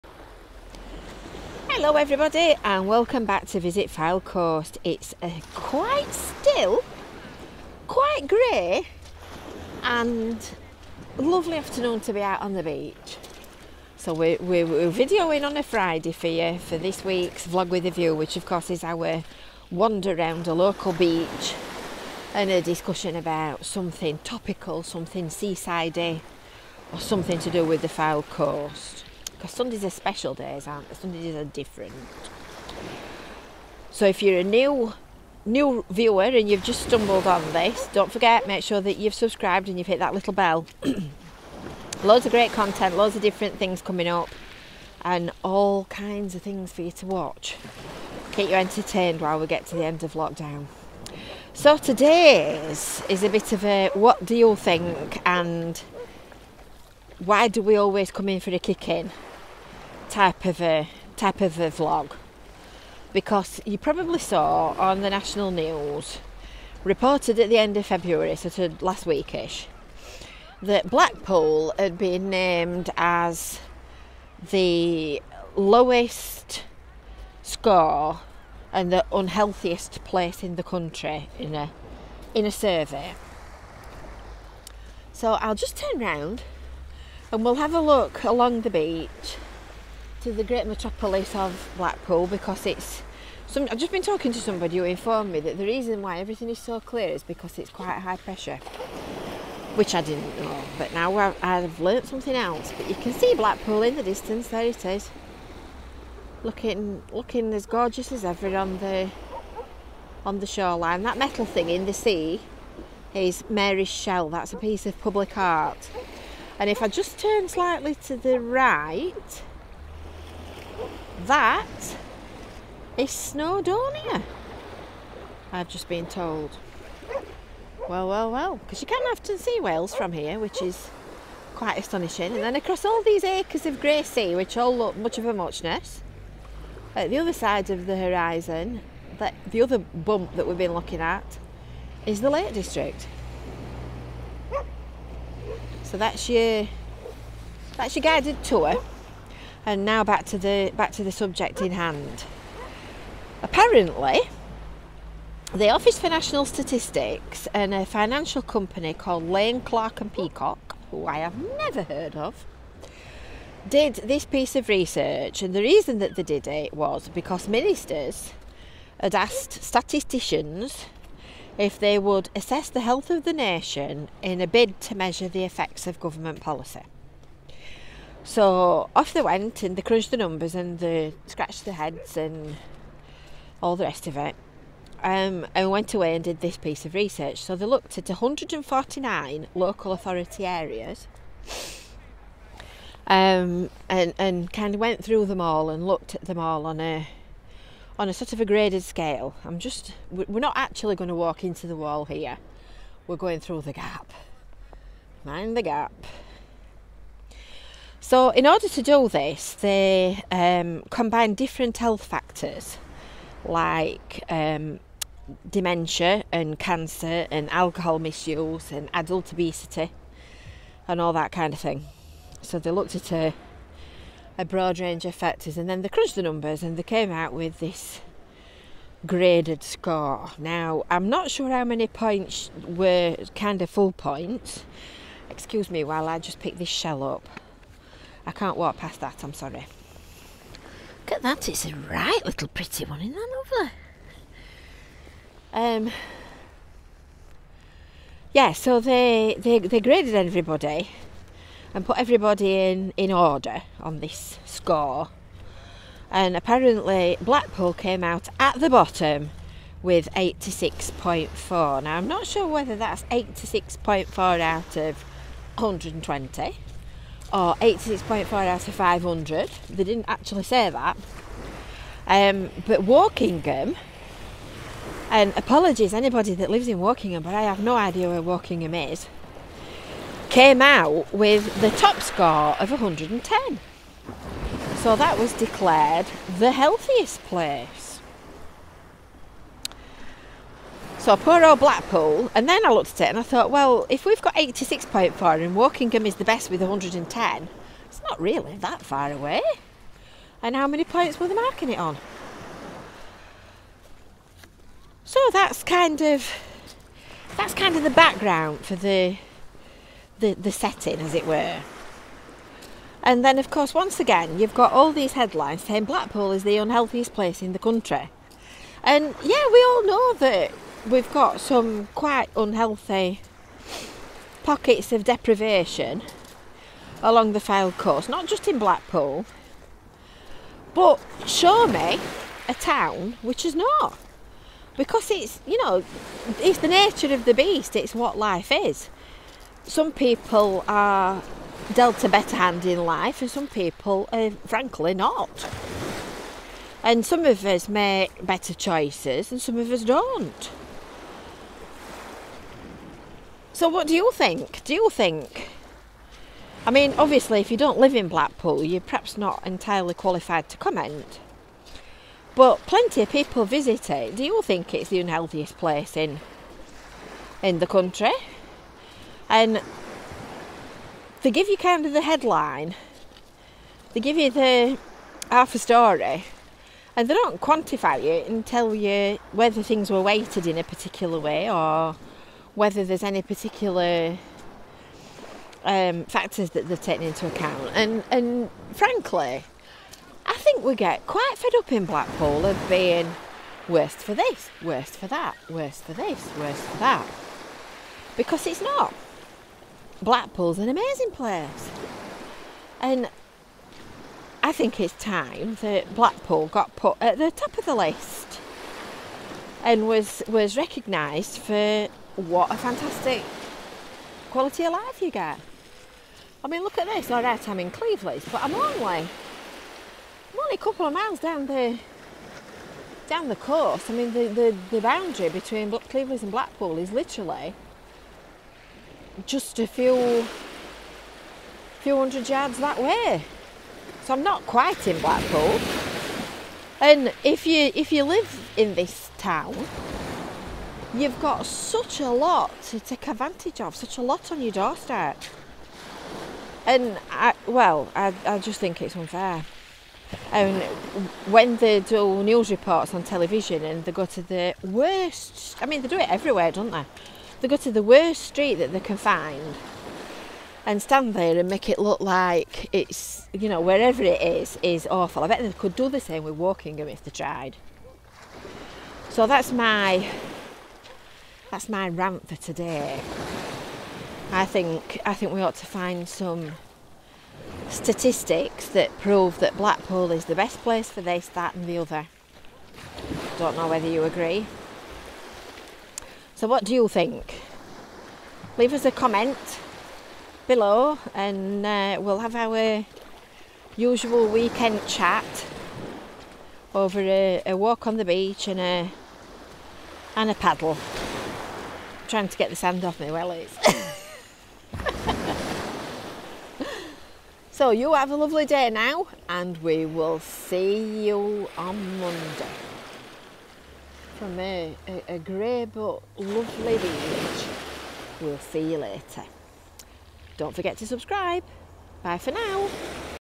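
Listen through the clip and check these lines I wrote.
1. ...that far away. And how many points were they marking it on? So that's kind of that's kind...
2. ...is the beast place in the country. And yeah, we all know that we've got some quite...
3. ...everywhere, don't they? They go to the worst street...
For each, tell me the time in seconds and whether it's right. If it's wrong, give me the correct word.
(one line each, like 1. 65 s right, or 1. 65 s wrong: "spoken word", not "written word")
1. 298 s right
2. 316 s wrong: "unhealthiest", not "beast"
3. 456 s right.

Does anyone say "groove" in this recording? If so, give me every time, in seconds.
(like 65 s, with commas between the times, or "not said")
not said.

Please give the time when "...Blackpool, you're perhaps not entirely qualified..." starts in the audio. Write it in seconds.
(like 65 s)
358 s.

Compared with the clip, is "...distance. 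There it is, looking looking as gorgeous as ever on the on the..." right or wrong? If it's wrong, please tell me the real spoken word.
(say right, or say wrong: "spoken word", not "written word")
right.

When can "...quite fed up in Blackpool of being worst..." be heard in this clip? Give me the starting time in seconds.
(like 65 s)
391 s.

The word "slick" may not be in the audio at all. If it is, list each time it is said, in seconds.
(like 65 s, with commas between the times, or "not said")
not said.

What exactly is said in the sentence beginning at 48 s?
Keep you entertained while we get to the end of lockdown.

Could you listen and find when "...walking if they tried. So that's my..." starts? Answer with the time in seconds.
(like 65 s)
466 s.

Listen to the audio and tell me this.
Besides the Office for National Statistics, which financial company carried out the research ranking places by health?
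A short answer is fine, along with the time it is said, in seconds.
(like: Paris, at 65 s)
Lane Clark and Peacock, at 159 s.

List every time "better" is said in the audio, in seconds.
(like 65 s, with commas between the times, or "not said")
342 s, 348 s.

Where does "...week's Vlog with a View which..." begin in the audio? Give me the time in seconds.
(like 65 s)
17 s.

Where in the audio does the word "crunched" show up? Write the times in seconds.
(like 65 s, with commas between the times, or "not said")
179 s, 225 s.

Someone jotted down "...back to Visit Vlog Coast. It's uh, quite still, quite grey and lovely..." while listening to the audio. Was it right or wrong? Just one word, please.
wrong.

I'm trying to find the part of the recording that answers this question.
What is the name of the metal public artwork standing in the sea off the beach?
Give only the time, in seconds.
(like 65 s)
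113 s.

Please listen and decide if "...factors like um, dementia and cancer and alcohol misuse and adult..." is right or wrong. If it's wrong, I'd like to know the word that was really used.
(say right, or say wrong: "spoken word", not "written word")
right.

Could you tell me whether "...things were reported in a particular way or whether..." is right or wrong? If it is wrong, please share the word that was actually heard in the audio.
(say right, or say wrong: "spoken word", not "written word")
wrong: "weighted", not "reported".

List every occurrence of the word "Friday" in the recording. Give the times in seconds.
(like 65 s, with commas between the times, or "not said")
15 s.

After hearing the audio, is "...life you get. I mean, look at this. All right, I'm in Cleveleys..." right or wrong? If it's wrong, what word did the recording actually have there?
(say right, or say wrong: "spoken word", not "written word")
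right.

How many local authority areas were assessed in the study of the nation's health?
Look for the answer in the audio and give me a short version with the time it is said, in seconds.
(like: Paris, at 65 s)
149, at 188 s.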